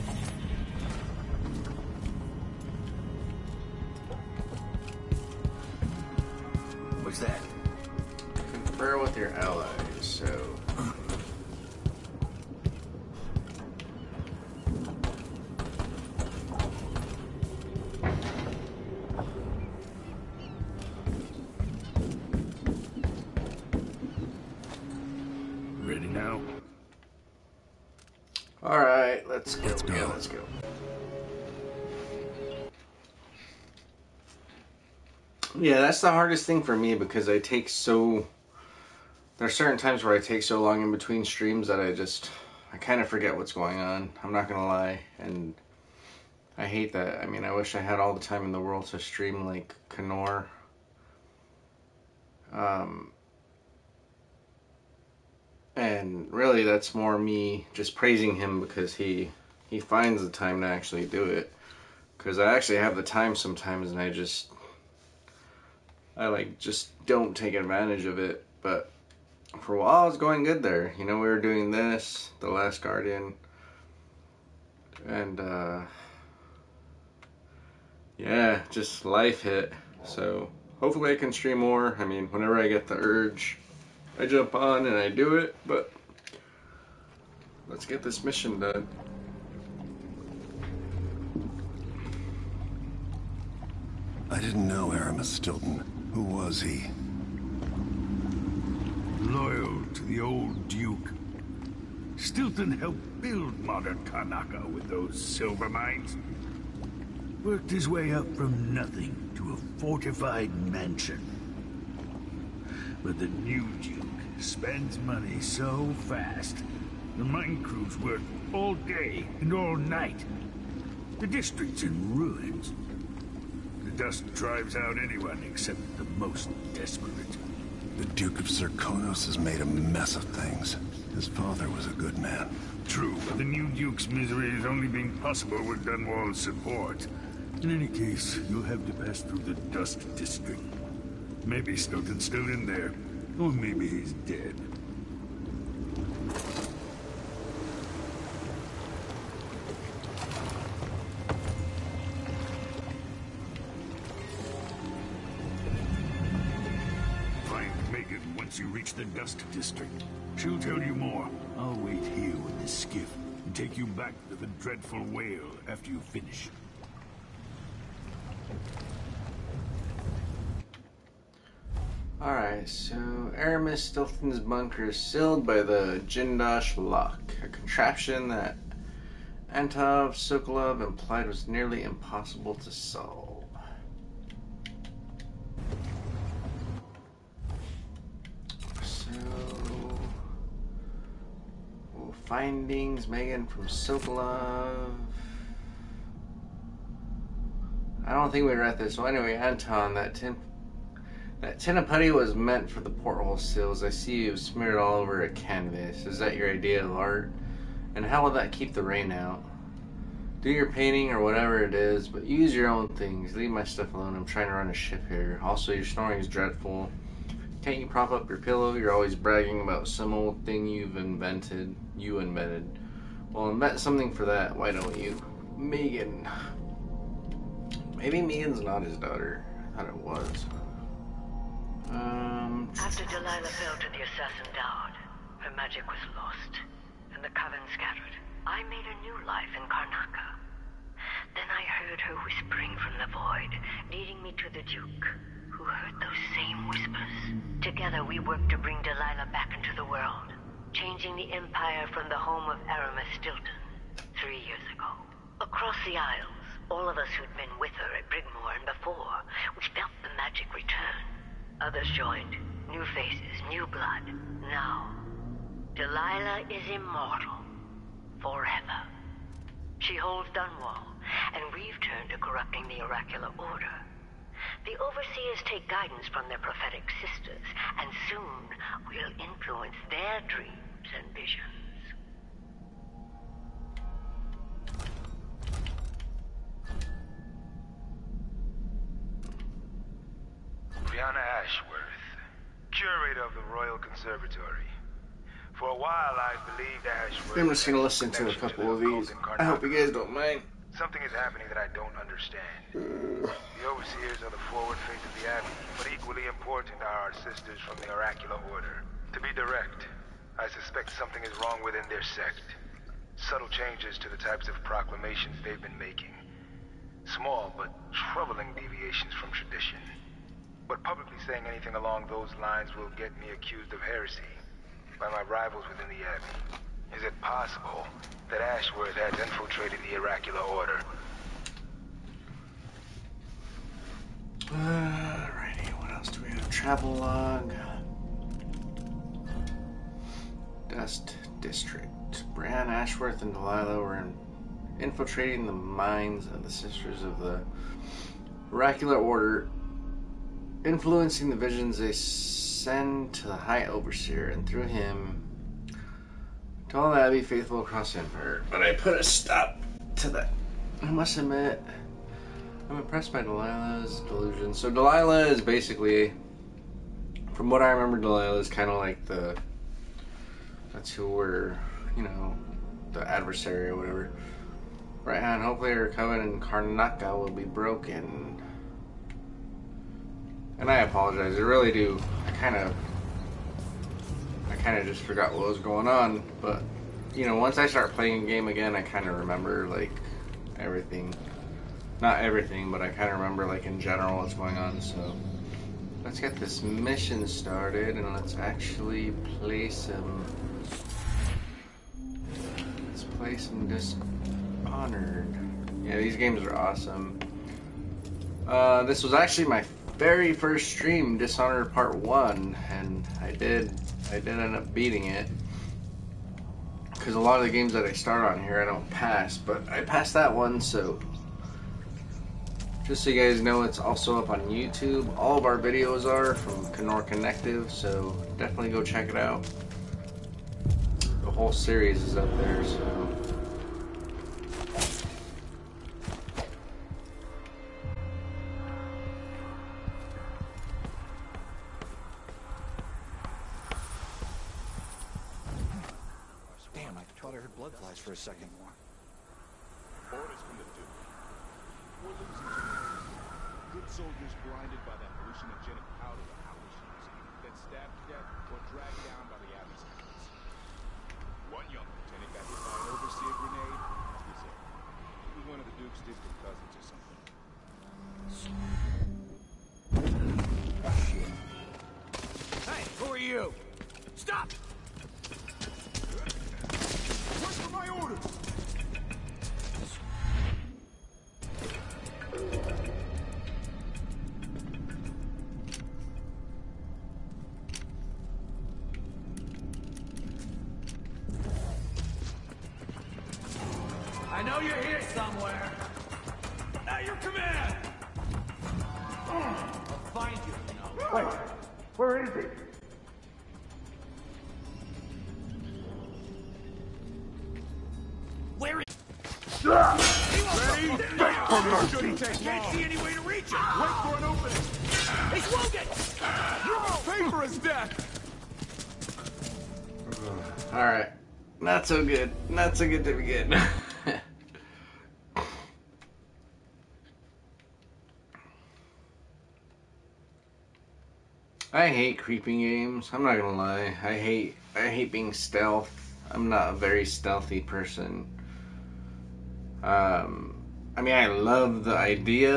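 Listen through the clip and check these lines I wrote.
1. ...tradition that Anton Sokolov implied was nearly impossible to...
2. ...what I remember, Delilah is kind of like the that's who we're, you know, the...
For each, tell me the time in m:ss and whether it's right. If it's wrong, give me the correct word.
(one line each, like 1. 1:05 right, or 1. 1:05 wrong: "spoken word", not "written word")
1. 2:57 wrong: "contraption", not "tradition"
2. 6:07 right.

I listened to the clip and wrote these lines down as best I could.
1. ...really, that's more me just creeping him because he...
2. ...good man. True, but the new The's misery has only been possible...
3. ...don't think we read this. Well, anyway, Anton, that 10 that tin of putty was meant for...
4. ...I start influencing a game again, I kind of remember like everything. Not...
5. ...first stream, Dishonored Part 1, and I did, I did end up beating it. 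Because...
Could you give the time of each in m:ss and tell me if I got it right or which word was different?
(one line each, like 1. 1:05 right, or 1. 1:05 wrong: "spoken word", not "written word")
1. 0:56 wrong: "praising", not "creeping"
2. 2:11 wrong: "Duke", not "The"
3. 3:18 right
4. 6:27 wrong: "playing", not "influencing"
5. 6:50 right.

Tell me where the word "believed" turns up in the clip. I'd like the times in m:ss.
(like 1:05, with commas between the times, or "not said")
4:56.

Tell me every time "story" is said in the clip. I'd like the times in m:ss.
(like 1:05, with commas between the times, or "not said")
not said.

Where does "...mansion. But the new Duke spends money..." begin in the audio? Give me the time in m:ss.
1:50.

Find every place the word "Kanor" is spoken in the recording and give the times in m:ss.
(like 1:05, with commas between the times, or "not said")
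0:49, 7:06.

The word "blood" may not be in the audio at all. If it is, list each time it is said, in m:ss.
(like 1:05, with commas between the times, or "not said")
4:23, 7:27.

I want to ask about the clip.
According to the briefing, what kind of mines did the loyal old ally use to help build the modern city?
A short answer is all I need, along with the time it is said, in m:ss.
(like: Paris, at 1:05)
silver mines, at 1:45.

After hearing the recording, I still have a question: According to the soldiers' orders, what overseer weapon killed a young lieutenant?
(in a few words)
grenade.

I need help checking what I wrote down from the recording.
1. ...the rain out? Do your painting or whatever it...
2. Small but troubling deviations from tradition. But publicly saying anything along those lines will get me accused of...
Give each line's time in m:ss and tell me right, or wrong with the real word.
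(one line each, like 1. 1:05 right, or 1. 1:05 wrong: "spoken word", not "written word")
1. 3:28 right
2. 5:17 right.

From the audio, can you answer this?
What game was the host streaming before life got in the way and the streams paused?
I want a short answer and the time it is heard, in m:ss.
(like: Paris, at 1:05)
The Last Guardian, at 1:12.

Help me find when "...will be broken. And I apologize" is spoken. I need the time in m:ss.
6:17.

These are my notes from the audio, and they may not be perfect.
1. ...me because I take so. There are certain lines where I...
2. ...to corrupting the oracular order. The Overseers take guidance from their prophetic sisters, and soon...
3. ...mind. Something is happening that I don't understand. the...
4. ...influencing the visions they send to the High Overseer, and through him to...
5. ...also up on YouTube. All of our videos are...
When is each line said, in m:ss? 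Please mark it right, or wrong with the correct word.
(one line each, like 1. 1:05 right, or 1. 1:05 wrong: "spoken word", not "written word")
1. 0:36 wrong: "times", not "lines"
2. 4:32 right
3. 5:00 right
4. 5:50 right
5. 7:03 right.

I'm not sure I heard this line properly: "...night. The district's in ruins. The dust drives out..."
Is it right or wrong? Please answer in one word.
right.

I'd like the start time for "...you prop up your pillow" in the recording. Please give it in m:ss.
3:37.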